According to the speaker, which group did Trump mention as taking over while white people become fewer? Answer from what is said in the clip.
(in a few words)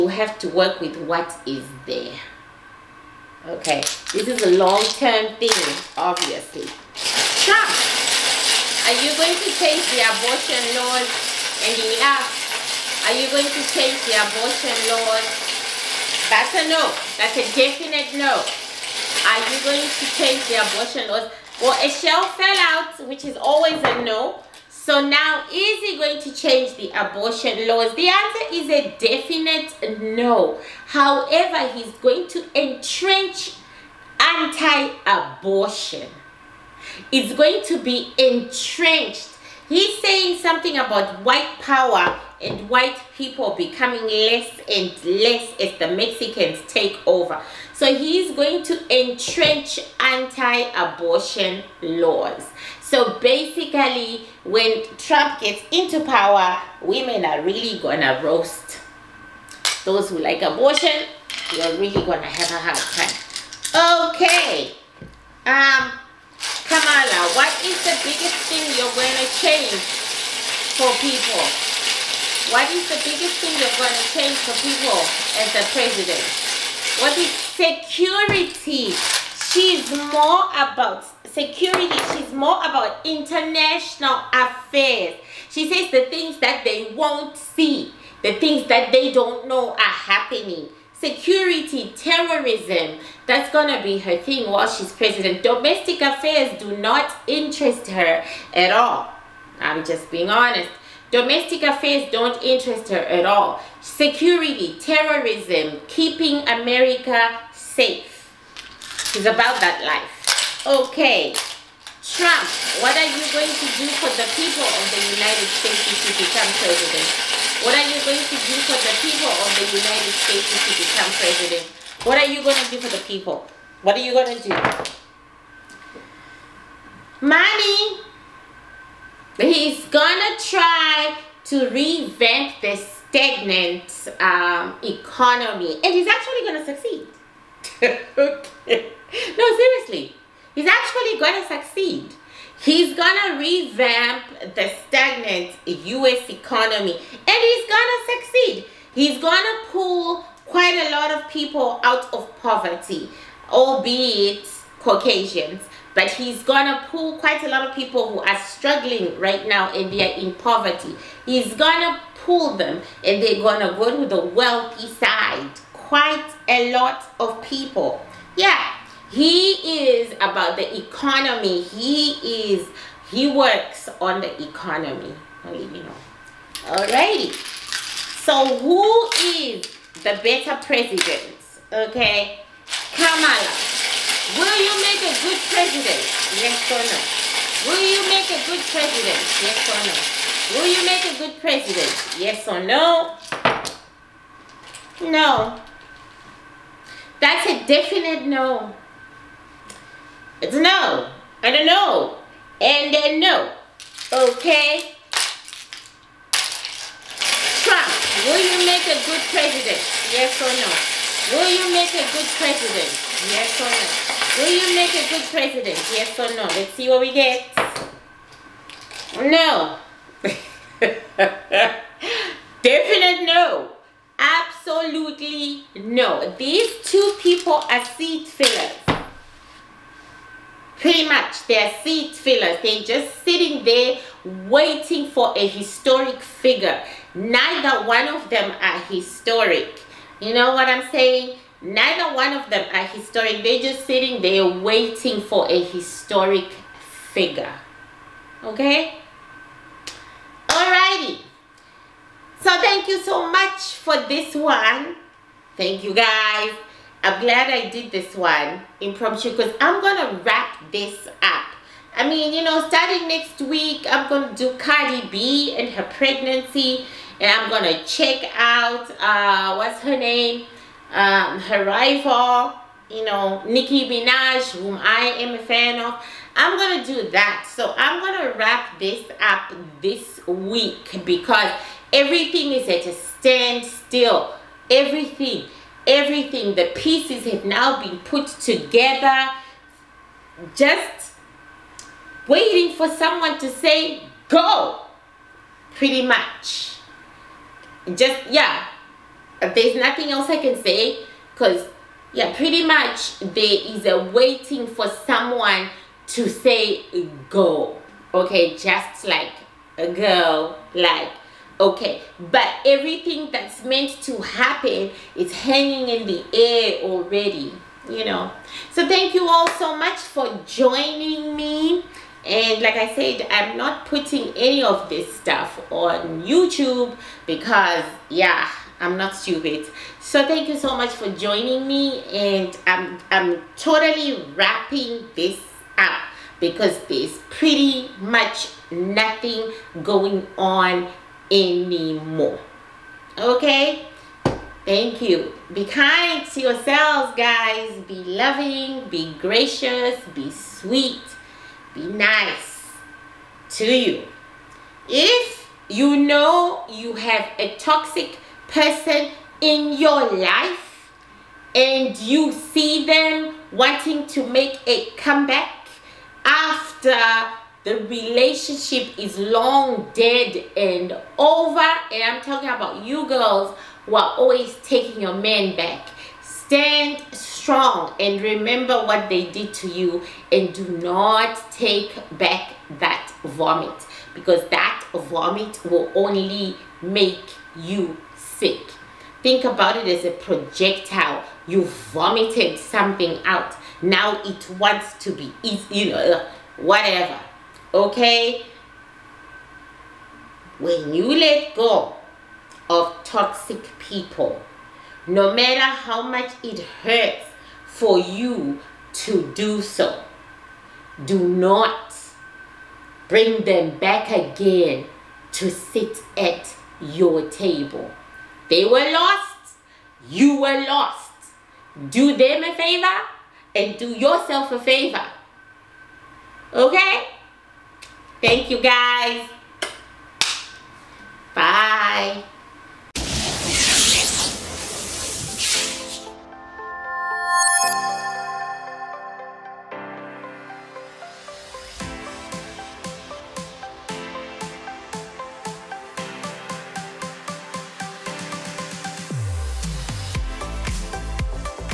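Mexicans.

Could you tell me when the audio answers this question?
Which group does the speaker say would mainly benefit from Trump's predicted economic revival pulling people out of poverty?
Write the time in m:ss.
2:34.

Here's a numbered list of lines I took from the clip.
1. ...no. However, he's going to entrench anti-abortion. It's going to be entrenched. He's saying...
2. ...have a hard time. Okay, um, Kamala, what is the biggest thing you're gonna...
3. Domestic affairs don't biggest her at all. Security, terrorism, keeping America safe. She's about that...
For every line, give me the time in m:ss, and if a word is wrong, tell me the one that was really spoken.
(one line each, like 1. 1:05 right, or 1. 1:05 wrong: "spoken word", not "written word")
1. 0:30 right
2. 1:02 right
3. 1:41 wrong: "interest", not "biggest".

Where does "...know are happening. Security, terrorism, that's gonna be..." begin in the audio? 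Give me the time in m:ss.
1:29.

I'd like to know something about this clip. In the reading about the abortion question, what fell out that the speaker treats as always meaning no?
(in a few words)
a shell.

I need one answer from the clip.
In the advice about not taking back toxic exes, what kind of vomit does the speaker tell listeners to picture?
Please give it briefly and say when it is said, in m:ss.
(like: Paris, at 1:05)
projectile, at 6:30.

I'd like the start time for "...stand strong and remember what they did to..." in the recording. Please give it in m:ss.
6:16.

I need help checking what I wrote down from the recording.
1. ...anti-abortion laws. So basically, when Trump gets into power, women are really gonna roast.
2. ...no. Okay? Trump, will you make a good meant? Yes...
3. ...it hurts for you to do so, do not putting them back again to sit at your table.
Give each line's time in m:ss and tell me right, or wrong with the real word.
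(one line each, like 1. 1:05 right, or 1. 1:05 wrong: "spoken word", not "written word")
1. 0:49 right
2. 3:23 wrong: "president", not "meant"
3. 6:46 wrong: "bring", not "putting".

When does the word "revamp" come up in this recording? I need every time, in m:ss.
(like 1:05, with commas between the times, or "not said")
2:11, 2:23.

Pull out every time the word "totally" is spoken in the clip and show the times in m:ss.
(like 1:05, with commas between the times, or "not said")
5:33.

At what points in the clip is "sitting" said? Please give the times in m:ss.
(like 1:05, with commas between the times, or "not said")
3:53, 4:03.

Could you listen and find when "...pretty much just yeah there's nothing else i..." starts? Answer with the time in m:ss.
4:55.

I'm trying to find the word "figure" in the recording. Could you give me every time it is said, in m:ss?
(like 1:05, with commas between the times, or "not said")
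3:56, 4:07.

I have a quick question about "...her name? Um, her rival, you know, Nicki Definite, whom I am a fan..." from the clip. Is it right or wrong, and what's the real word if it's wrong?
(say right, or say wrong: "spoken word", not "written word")
wrong: "Minaj", not "Definite".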